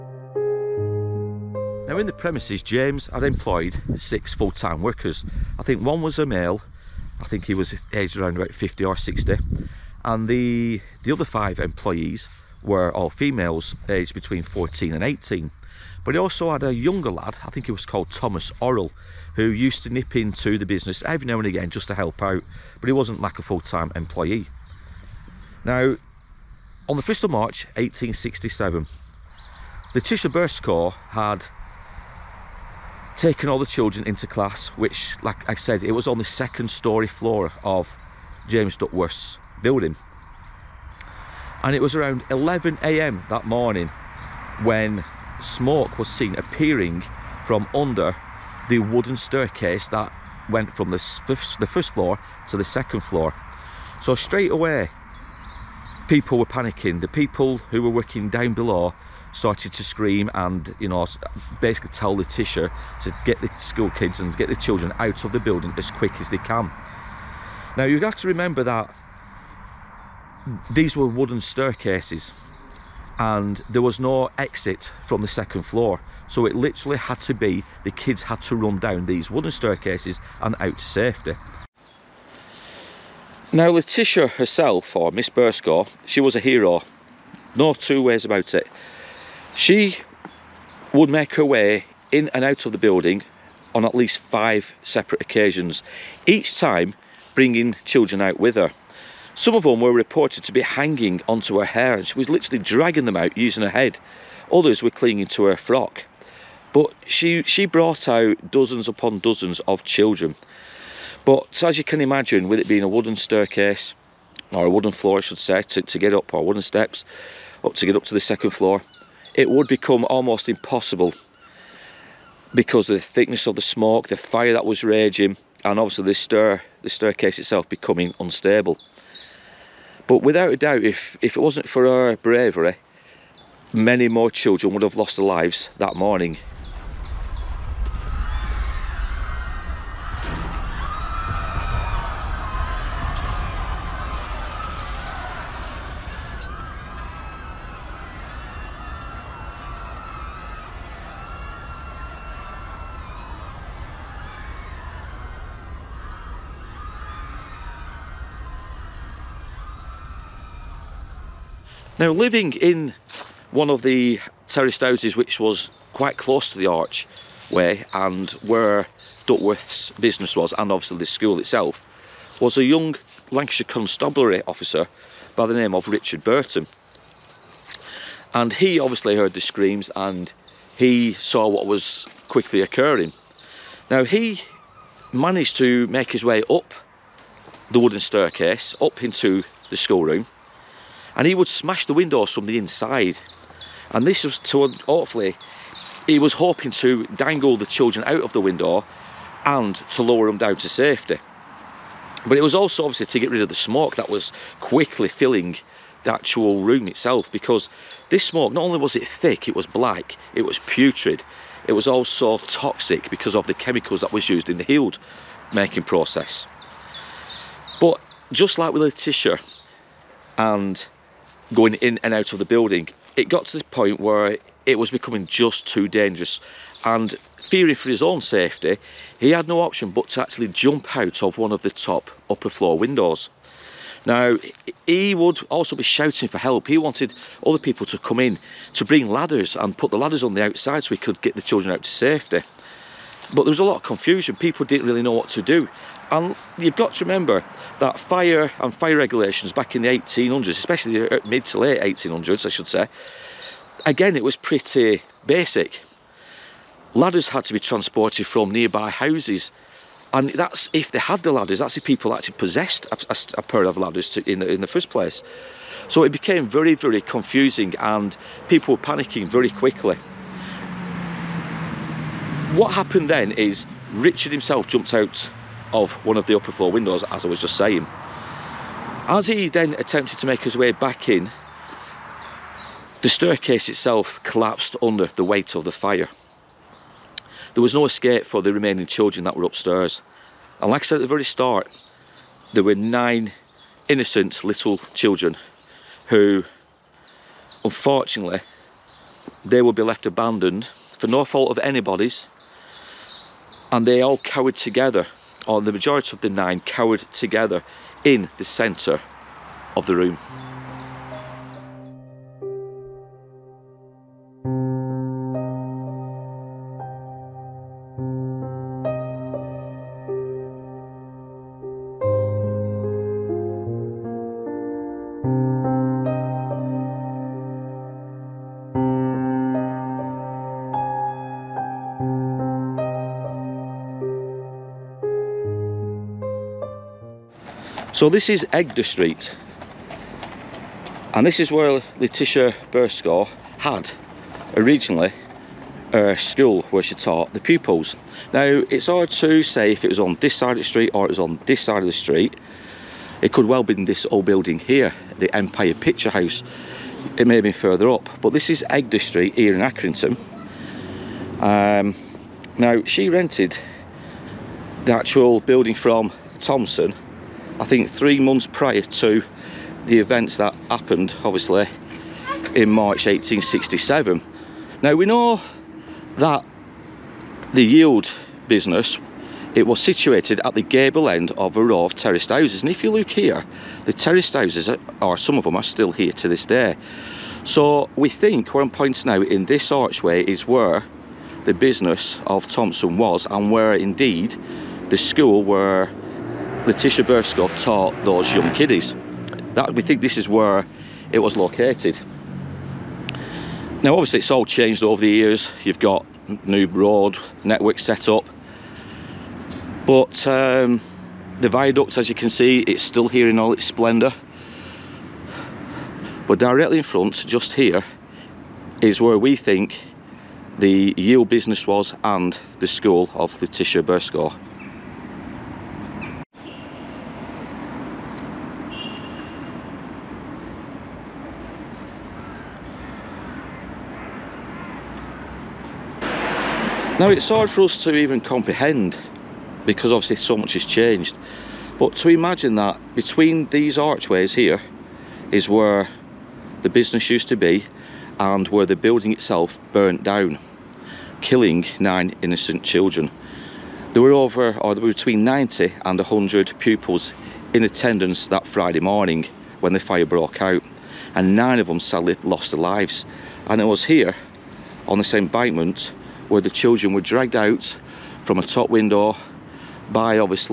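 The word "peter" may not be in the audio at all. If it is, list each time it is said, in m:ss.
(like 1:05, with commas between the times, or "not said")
not said.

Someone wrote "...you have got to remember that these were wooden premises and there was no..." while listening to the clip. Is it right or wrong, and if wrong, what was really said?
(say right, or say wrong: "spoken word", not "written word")
wrong: "staircases", not "premises".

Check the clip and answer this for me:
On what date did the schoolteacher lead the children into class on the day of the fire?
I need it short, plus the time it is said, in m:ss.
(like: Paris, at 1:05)
1 March 1867, at 0:27.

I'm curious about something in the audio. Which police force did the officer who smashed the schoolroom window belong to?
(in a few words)
Lancashire Constabulary.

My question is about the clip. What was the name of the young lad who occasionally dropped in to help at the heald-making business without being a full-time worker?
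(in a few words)
Thomas Orrell.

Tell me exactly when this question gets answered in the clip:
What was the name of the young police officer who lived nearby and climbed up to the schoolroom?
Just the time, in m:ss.
2:55.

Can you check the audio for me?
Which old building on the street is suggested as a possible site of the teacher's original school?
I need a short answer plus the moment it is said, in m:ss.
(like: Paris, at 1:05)
Empire Picture House, at 5:55.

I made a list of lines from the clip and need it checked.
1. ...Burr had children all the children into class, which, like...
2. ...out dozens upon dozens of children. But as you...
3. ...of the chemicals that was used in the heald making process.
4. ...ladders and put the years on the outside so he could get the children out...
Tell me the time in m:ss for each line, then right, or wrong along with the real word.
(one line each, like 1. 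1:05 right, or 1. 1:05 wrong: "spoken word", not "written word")
1. 0:30 wrong: "taken", not "children"
2. 1:48 right
3. 3:33 right
4. 3:59 wrong: "ladders", not "years".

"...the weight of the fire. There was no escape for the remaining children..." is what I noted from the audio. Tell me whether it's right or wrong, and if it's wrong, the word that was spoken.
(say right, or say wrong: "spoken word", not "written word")
right.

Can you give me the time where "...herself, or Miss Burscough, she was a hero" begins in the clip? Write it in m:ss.
1:24.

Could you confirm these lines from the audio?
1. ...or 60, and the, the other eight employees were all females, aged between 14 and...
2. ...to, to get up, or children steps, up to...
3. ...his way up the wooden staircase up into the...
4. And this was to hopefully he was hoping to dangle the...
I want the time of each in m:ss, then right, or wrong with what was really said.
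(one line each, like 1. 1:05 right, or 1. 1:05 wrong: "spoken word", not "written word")
1. 0:08 wrong: "five", not "eight"
2. 1:55 wrong: "wooden", not "children"
3. 3:06 right
4. 3:13 right.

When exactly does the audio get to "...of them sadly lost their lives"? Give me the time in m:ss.
7:41.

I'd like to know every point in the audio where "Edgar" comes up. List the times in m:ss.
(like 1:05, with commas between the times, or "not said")
5:38, 5:58.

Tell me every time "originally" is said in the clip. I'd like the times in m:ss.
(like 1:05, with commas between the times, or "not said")
5:44.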